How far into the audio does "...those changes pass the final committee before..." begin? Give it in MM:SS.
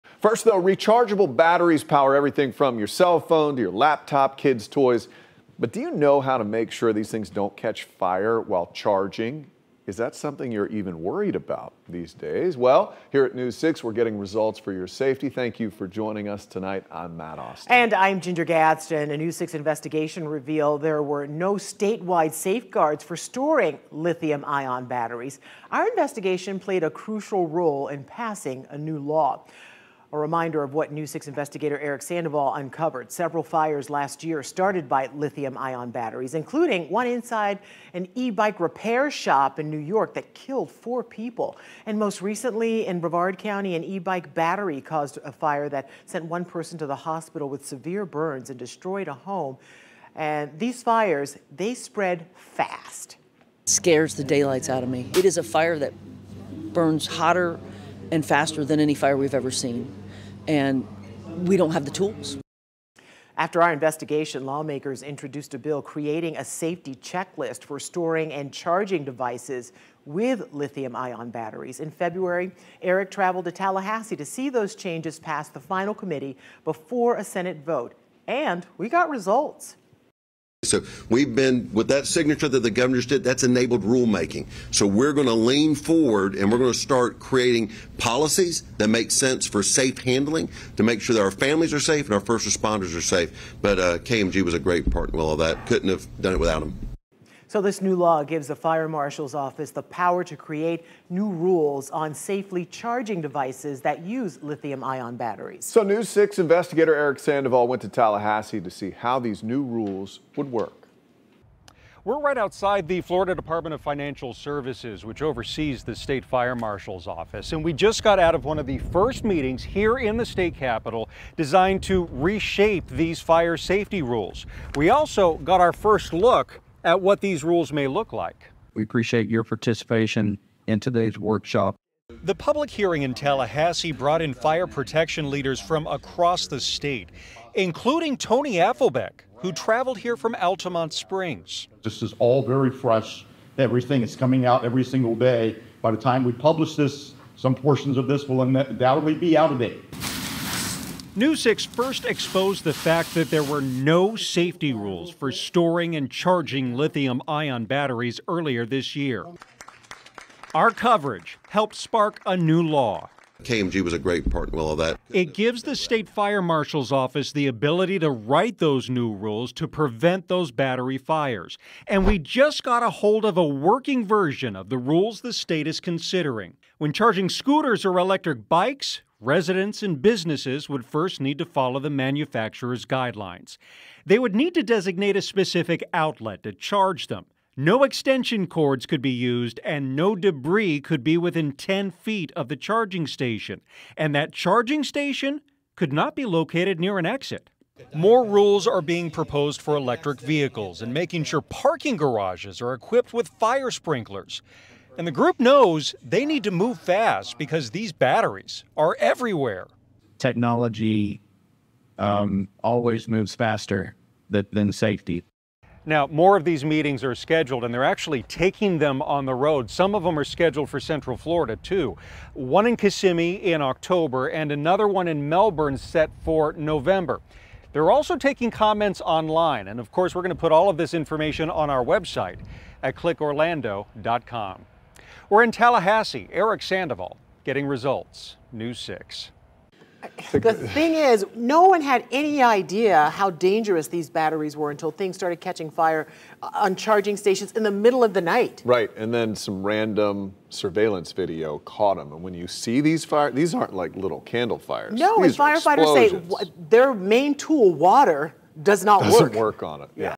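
01:14.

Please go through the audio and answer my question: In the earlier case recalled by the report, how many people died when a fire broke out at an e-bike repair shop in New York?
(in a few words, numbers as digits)
4.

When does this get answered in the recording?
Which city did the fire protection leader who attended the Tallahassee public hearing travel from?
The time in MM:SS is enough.
02:20.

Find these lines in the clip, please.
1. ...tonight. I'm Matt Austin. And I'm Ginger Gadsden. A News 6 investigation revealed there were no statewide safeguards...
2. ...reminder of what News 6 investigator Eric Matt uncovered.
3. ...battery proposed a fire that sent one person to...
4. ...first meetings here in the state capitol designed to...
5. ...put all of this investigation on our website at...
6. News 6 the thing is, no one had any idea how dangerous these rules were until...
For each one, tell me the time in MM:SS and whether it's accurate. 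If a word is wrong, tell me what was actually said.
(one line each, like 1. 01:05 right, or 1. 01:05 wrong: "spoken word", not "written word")
1. 00:16 right
2. 00:30 wrong: "Sandoval", not "Matt"
3. 00:44 wrong: "caused", not "proposed"
4. 01:58 right
5. 03:50 wrong: "information", not "investigation"
6. 03:58 wrong: "batteries", not "rules".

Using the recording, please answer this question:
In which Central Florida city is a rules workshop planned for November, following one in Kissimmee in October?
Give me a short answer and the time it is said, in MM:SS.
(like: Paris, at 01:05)
Melbourne, at 03:45.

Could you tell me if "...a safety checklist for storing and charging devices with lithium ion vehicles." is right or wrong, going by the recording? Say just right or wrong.
wrong.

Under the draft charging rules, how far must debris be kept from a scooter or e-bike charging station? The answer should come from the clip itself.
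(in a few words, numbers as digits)
10 feet.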